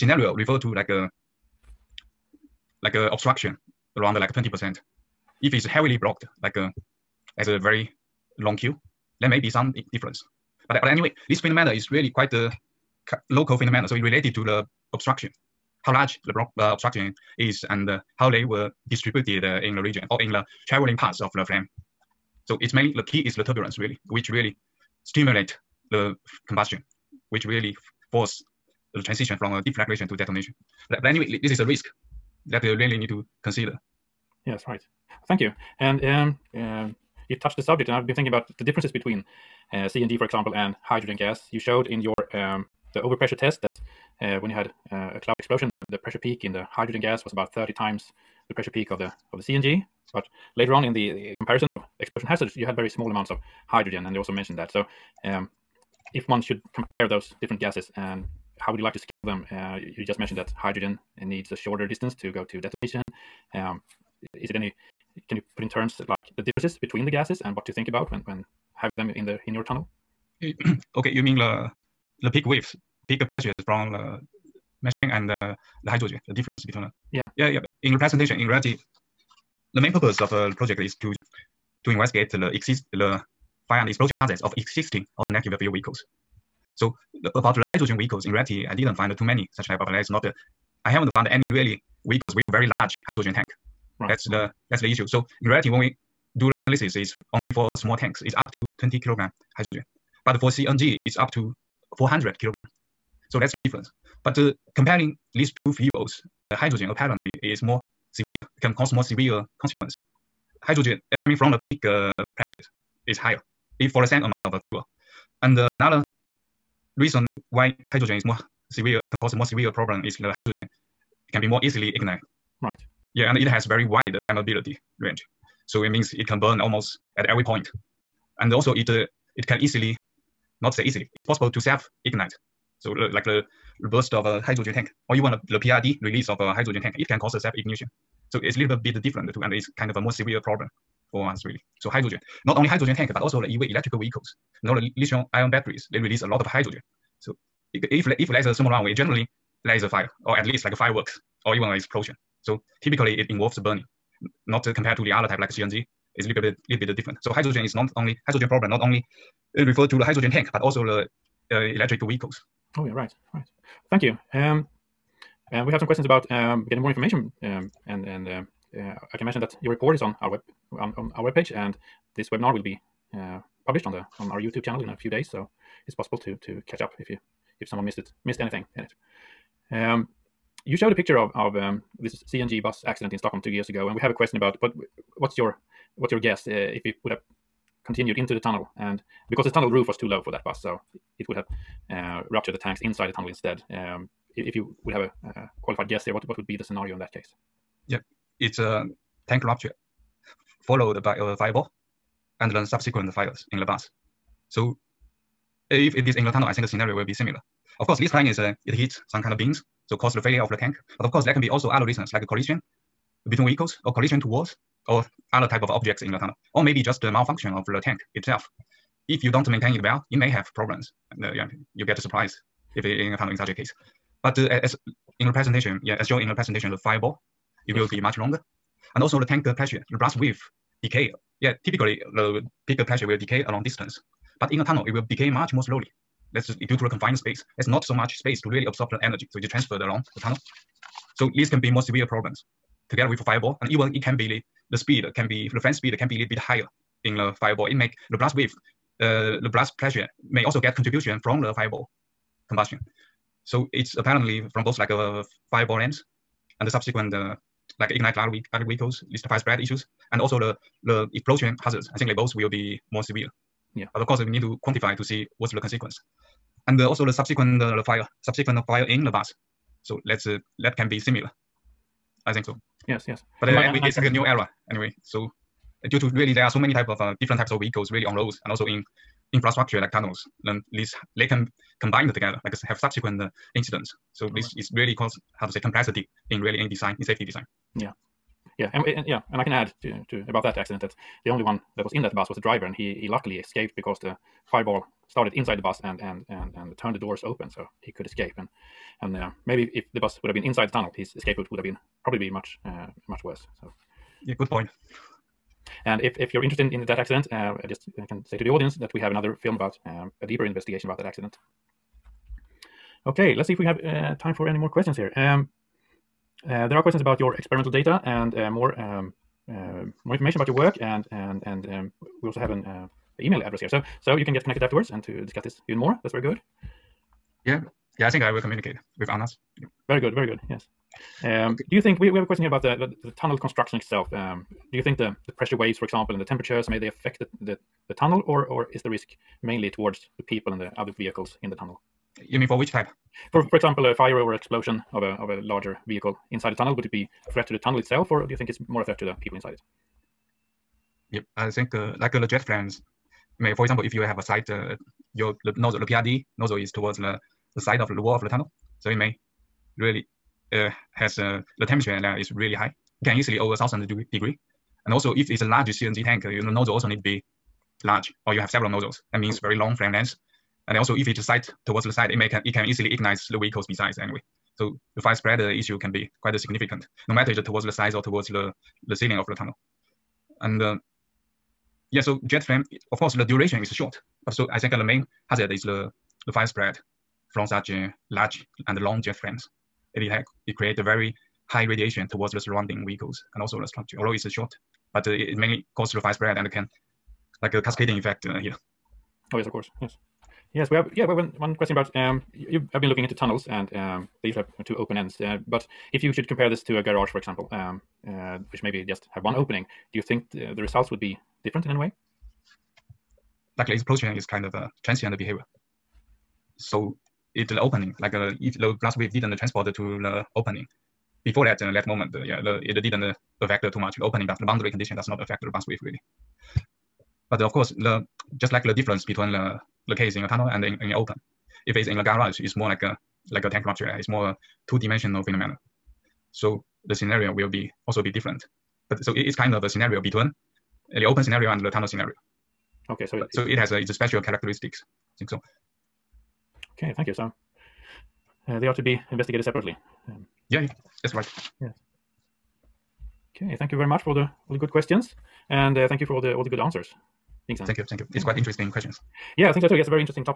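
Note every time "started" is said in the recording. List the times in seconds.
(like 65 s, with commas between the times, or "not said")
295 s.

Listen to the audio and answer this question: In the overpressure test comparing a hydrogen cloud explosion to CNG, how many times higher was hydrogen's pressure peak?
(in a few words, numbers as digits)
30 times.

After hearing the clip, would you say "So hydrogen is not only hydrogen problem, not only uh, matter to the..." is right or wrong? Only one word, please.
wrong.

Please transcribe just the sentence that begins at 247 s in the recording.
It make the blast wave, uh, the blast pressure may also get contribution from the fireball combustion.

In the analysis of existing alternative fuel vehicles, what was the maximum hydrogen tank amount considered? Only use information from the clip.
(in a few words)
20 kilograms.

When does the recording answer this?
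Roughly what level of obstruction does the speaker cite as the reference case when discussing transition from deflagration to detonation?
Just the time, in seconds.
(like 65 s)
3 s.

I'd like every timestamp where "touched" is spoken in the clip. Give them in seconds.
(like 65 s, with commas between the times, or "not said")
37 s.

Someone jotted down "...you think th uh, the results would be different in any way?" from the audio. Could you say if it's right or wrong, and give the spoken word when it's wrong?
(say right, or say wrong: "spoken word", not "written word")
right.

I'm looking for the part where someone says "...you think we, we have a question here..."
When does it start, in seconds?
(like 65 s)
331 s.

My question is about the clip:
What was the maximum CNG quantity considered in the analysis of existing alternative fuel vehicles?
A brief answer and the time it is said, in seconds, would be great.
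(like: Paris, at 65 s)
400 kilograms, at 101 s.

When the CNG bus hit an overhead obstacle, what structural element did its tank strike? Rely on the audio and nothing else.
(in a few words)
beams.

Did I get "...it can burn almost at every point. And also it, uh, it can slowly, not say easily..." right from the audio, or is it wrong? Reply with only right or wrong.
wrong.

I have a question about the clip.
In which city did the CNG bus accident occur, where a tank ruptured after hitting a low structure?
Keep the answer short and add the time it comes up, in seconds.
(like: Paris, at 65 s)
Stockholm, at 183 s.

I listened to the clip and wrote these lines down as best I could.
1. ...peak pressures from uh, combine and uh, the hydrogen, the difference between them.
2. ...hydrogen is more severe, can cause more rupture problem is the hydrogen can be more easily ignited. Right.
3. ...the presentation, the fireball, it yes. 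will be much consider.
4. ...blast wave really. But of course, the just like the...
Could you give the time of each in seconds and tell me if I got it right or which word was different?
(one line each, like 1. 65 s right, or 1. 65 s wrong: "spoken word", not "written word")
1. 73 s wrong: "methane", not "combine"
2. 117 s wrong: "severe", not "rupture"
3. 226 s wrong: "longer", not "consider"
4. 425 s right.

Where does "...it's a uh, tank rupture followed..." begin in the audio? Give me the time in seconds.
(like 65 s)
198 s.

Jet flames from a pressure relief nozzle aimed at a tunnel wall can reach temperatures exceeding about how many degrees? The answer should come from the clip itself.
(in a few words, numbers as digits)
1000 degrees.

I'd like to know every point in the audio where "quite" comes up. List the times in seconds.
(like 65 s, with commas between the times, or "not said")
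12 s, 376 s, 458 s.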